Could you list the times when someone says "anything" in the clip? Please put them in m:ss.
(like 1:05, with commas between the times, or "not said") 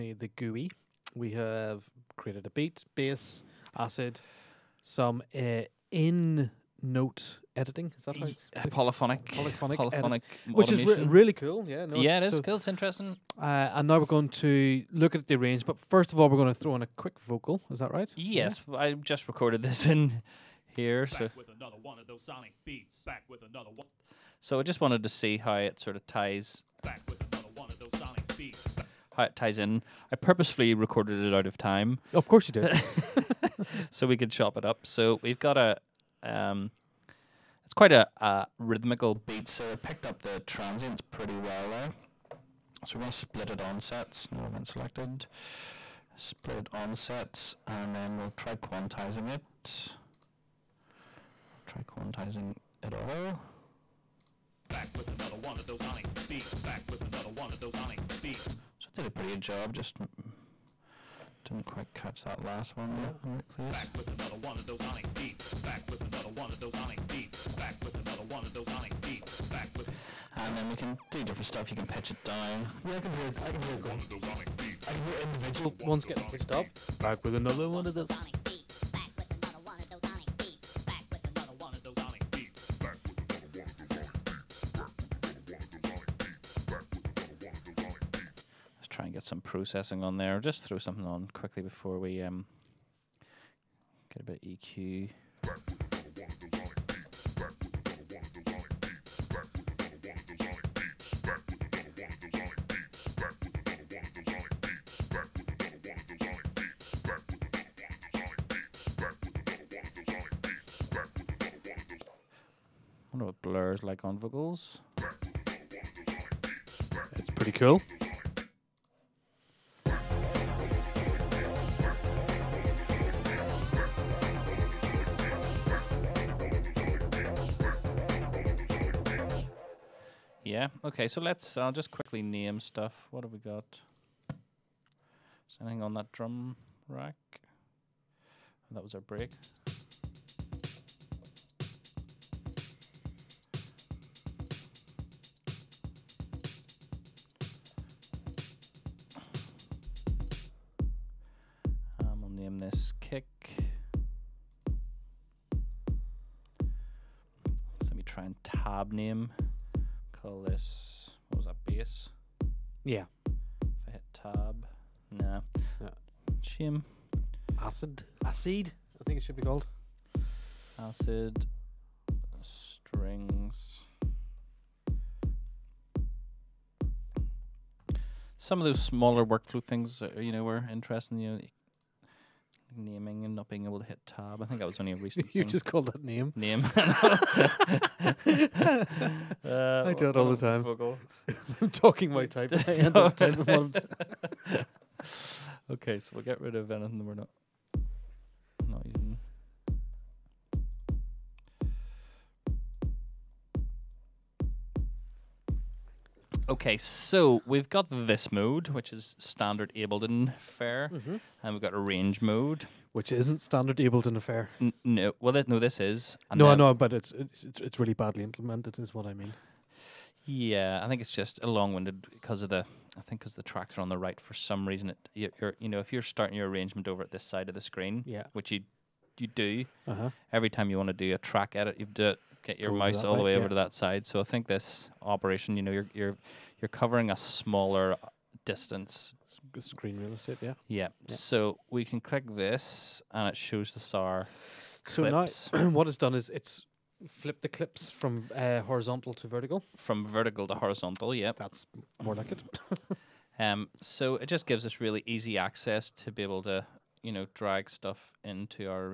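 2:15, 3:16.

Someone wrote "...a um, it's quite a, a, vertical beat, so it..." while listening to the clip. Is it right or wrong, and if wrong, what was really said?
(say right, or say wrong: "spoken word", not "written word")
wrong: "rhythmical", not "vertical".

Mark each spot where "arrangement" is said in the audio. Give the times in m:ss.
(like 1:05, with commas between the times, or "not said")
3:46.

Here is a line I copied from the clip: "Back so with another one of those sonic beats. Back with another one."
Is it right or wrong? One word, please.
right.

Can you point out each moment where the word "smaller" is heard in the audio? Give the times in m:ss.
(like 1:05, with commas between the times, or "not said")
2:58, 3:57.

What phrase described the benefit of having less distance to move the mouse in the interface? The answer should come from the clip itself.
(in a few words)
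Screen real estate.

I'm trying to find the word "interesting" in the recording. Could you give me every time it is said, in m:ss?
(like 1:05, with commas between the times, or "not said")
0:12, 3:00.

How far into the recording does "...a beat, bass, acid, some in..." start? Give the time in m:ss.
0:02.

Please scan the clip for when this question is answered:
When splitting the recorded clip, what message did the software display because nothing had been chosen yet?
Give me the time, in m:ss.
0:44.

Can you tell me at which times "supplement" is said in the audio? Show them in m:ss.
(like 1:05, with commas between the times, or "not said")
not said.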